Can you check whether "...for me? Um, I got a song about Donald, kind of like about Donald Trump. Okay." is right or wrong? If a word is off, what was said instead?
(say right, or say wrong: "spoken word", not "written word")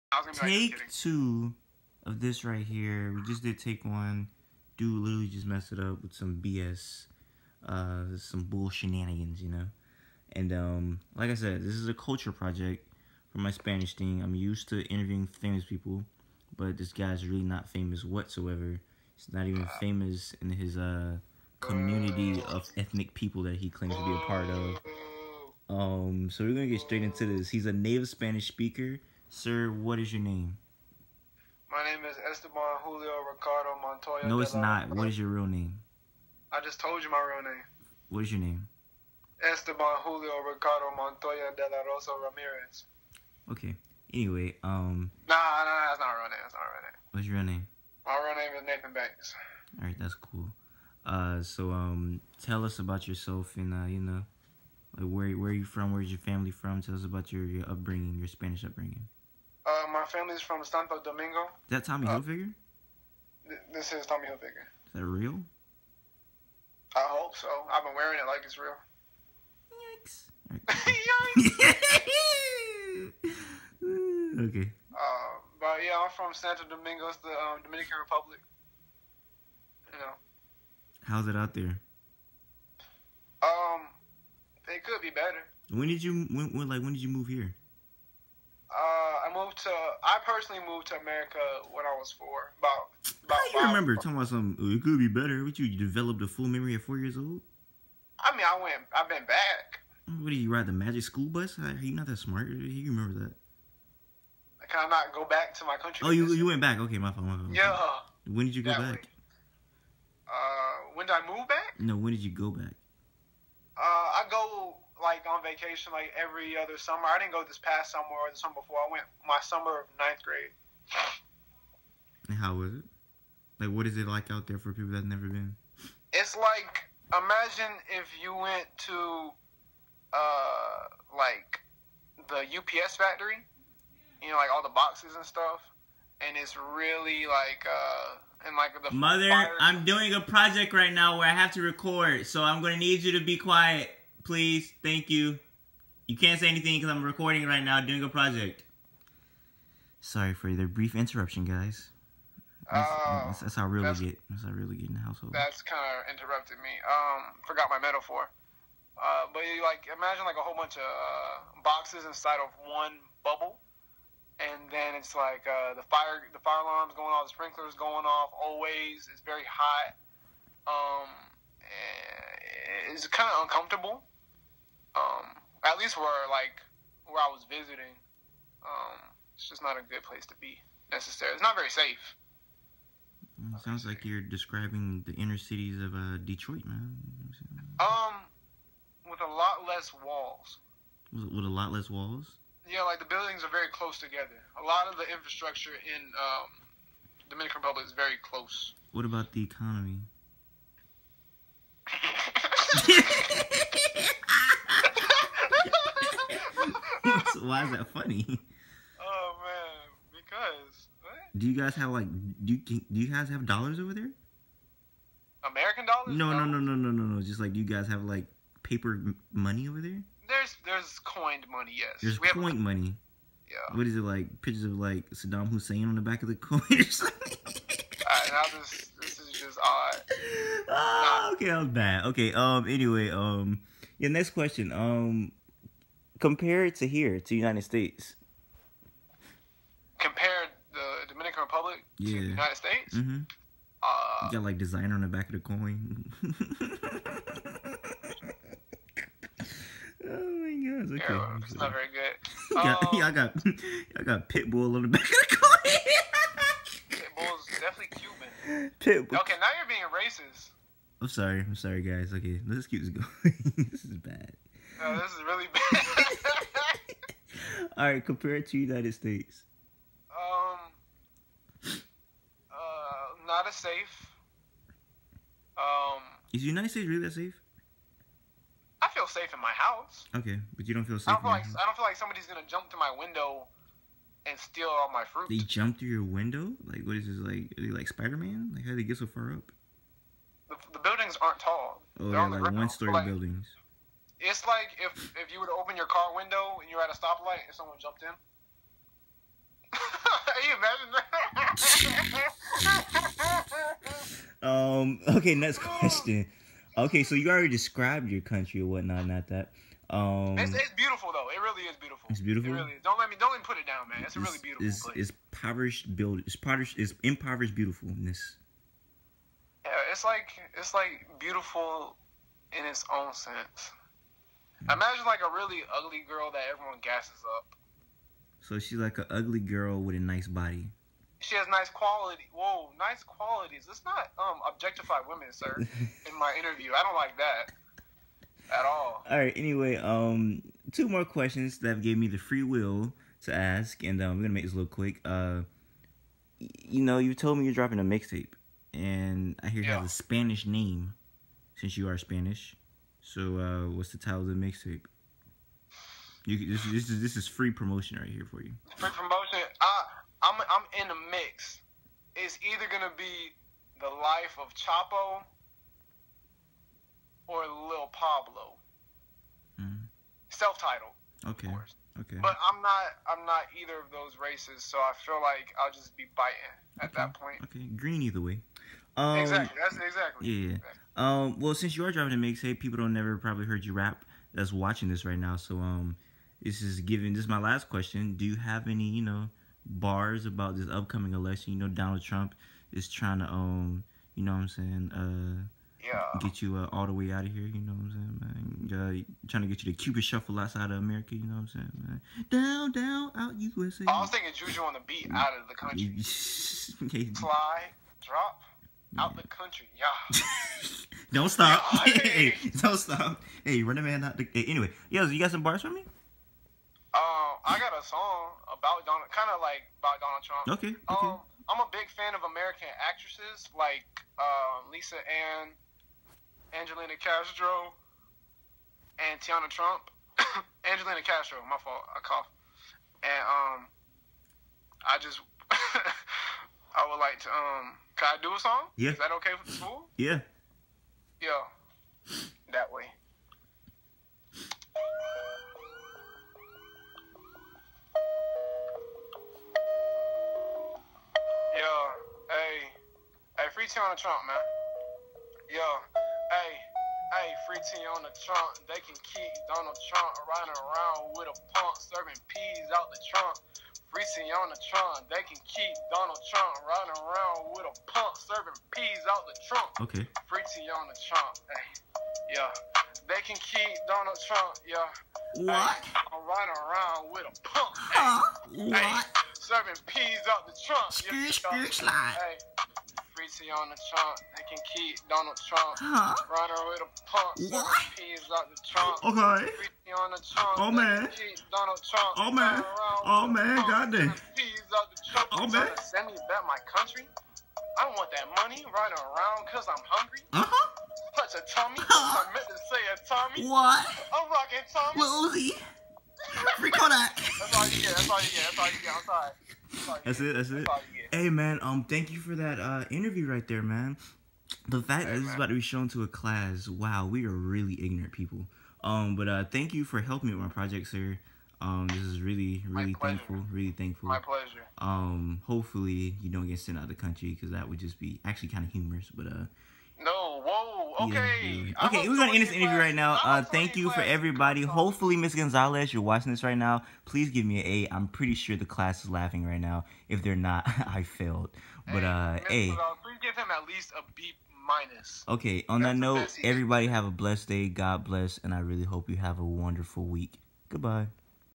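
right.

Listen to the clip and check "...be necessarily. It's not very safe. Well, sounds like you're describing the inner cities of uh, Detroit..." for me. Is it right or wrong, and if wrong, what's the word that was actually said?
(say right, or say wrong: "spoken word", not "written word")
right.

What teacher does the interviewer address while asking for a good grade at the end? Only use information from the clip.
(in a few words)
Miss Gonzalez.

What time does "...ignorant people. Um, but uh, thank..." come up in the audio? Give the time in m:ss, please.
8:37.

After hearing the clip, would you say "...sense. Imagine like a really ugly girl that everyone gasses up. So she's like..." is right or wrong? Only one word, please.
right.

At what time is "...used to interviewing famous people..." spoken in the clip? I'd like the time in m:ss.
0:14.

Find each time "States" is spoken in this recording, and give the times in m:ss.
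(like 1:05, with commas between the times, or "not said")
3:57, 4:02, 4:28, 4:36.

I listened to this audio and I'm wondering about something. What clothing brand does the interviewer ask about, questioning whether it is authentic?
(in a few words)
Tommy Hilfiger.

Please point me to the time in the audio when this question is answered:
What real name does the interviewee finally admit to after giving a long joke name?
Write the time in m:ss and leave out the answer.
0:48.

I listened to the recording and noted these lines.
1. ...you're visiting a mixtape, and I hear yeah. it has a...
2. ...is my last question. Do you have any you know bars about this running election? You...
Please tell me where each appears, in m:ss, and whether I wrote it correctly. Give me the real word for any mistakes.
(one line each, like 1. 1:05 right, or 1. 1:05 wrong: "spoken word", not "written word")
1. 5:47 wrong: "dropping", not "visiting"
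2. 6:27 wrong: "upcoming", not "running".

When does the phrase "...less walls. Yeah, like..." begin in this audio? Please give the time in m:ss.
3:11.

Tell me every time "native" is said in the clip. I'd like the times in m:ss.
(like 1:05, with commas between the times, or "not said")
0:27.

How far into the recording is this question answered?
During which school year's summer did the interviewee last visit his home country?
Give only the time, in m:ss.
1:59.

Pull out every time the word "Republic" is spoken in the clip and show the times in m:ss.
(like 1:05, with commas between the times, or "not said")
1:17, 3:17, 4:01.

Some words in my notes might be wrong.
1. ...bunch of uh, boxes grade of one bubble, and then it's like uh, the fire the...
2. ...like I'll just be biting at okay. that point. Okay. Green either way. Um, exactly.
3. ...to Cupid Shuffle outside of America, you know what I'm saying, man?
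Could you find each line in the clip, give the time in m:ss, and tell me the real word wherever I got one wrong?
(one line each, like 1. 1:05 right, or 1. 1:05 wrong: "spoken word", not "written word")
1. 2:40 wrong: "inside", not "grade"
2. 6:15 right
3. 6:39 right.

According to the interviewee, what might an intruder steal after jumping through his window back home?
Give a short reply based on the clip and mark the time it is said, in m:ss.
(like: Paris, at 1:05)
Fruit, at 4:45.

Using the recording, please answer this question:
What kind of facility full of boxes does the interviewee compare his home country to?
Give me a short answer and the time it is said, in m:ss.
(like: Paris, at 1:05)
UPS factory, at 2:12.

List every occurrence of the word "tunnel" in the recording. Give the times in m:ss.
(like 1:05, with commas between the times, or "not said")
not said.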